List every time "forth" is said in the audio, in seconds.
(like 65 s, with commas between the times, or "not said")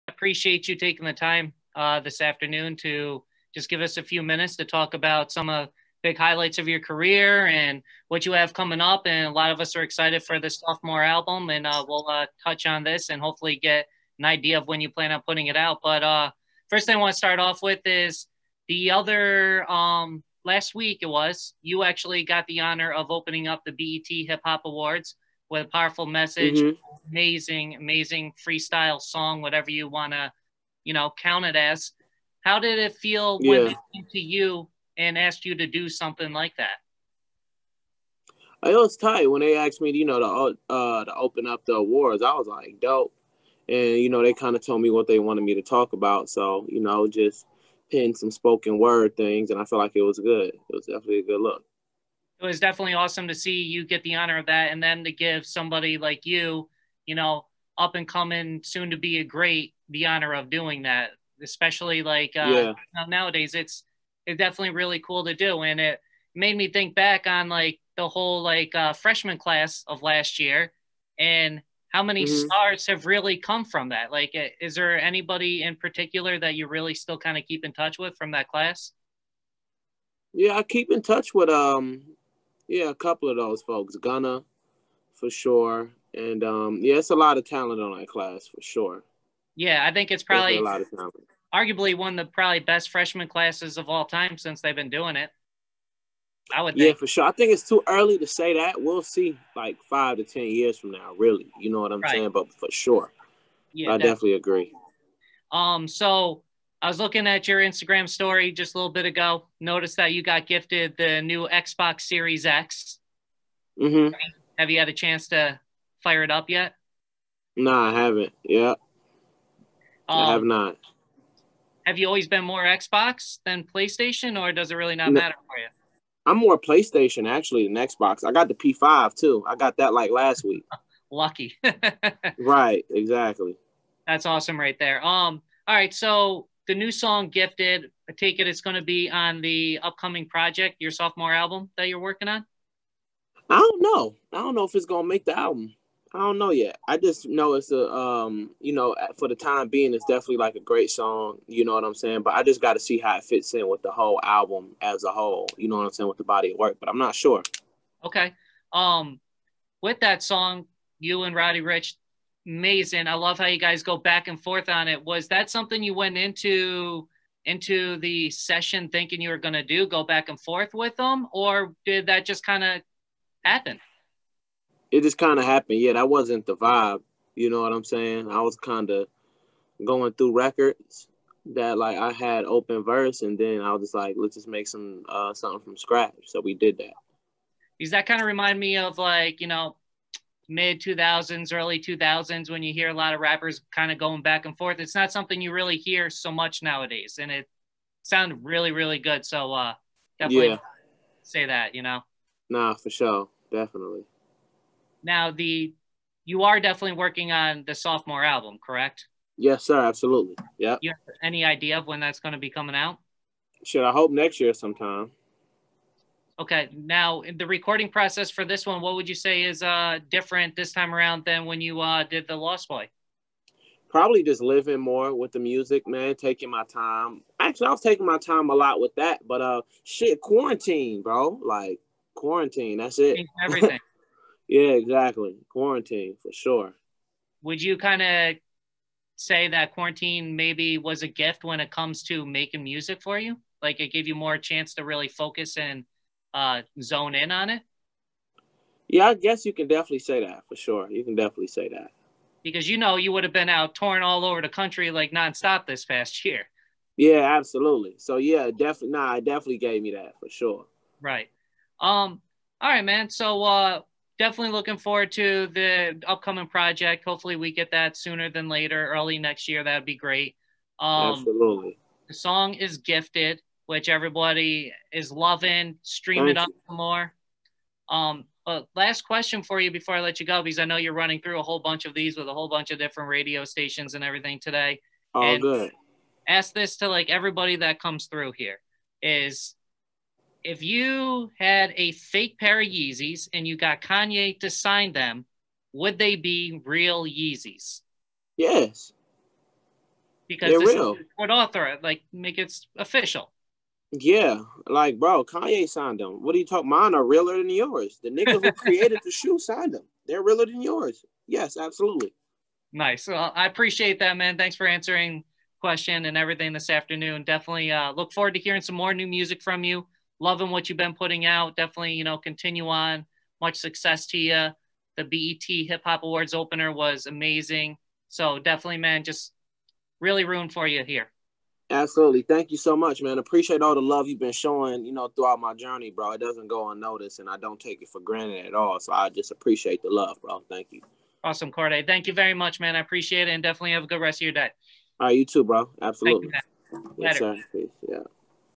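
164 s, 170 s, 194 s.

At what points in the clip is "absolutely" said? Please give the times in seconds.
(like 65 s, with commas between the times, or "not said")
209 s, 257 s, 271 s, 311 s, 331 s, 345 s.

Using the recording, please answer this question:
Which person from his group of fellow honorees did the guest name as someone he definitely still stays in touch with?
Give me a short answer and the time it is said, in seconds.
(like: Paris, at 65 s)
Gunna, at 83 s.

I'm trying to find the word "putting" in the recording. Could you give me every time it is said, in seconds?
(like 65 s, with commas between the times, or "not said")
15 s, 320 s.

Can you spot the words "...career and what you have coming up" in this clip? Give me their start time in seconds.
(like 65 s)
6 s.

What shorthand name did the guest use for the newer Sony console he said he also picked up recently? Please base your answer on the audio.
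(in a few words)
P5.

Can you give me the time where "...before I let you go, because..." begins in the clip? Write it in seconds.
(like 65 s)
279 s.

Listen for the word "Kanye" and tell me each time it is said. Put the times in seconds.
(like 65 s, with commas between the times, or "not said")
293 s, 305 s.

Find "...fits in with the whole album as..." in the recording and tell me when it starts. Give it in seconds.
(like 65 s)
153 s.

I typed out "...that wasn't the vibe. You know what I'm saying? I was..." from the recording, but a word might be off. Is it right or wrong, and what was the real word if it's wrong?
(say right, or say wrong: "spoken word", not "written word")
right.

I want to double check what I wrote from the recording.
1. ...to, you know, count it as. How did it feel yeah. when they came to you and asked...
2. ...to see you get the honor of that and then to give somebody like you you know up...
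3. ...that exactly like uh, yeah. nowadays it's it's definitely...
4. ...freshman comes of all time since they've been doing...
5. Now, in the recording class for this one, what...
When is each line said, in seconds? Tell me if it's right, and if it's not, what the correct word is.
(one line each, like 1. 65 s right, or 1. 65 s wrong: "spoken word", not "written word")
1. 30 s right
2. 53 s right
3. 60 s wrong: "especially", not "exactly"
4. 92 s wrong: "classes", not "comes"
5. 216 s wrong: "process", not "class".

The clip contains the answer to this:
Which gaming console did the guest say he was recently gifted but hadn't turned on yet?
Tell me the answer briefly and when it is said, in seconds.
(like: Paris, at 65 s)
Xbox Series X, at 111 s.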